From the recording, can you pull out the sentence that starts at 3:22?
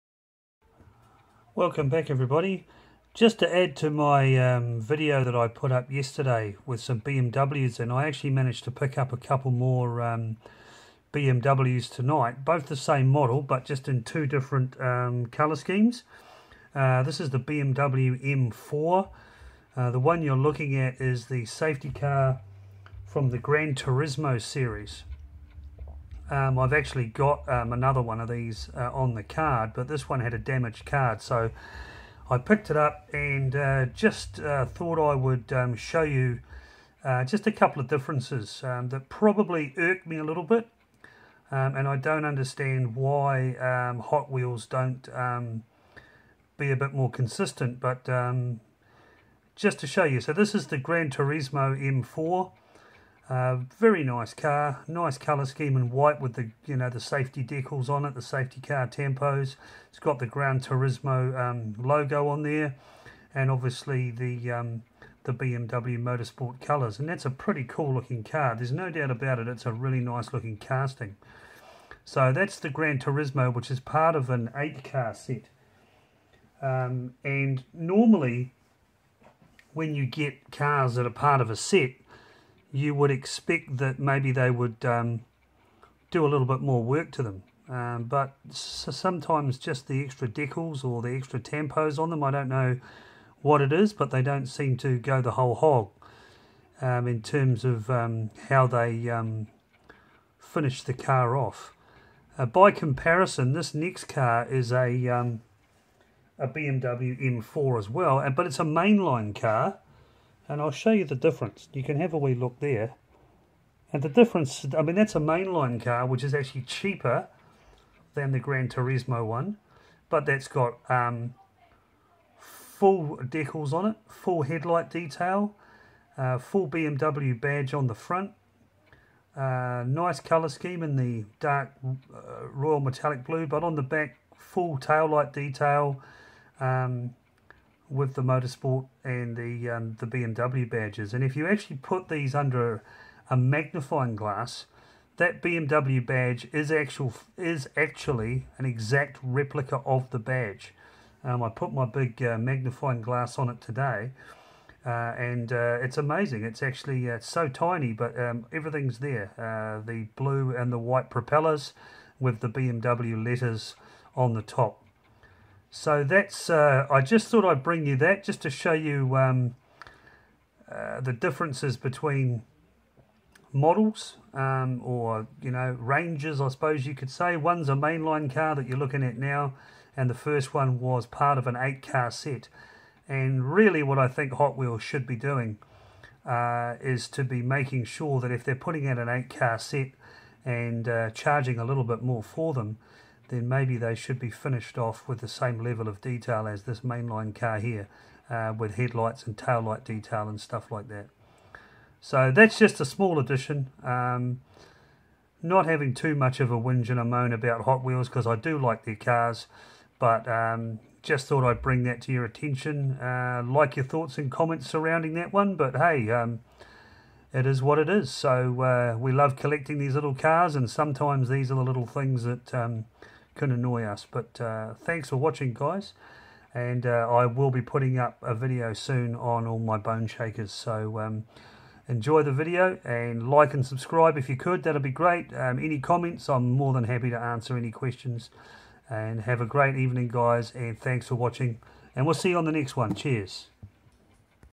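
So that's just a small addition.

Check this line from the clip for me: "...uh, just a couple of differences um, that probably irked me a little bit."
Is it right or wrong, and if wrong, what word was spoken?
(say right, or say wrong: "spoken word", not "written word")
right.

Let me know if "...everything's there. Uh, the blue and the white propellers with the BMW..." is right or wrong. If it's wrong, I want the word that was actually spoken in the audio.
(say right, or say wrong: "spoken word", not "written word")
right.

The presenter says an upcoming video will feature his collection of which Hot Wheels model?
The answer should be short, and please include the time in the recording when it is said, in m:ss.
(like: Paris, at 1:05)
Bone Shakers, at 3:49.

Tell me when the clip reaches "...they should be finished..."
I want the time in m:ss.
3:13.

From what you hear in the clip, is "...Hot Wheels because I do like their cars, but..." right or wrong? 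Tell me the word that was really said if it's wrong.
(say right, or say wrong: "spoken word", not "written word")
right.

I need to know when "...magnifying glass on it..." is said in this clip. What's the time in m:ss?
2:32.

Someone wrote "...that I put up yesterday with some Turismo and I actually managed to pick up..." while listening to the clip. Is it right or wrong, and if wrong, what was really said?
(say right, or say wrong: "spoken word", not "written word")
wrong: "BMWs", not "Turismo".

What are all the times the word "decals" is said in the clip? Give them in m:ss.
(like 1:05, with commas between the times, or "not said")
0:57, 1:30, 2:03.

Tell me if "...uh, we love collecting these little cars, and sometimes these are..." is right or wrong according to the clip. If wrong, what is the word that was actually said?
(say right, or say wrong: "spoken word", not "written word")
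right.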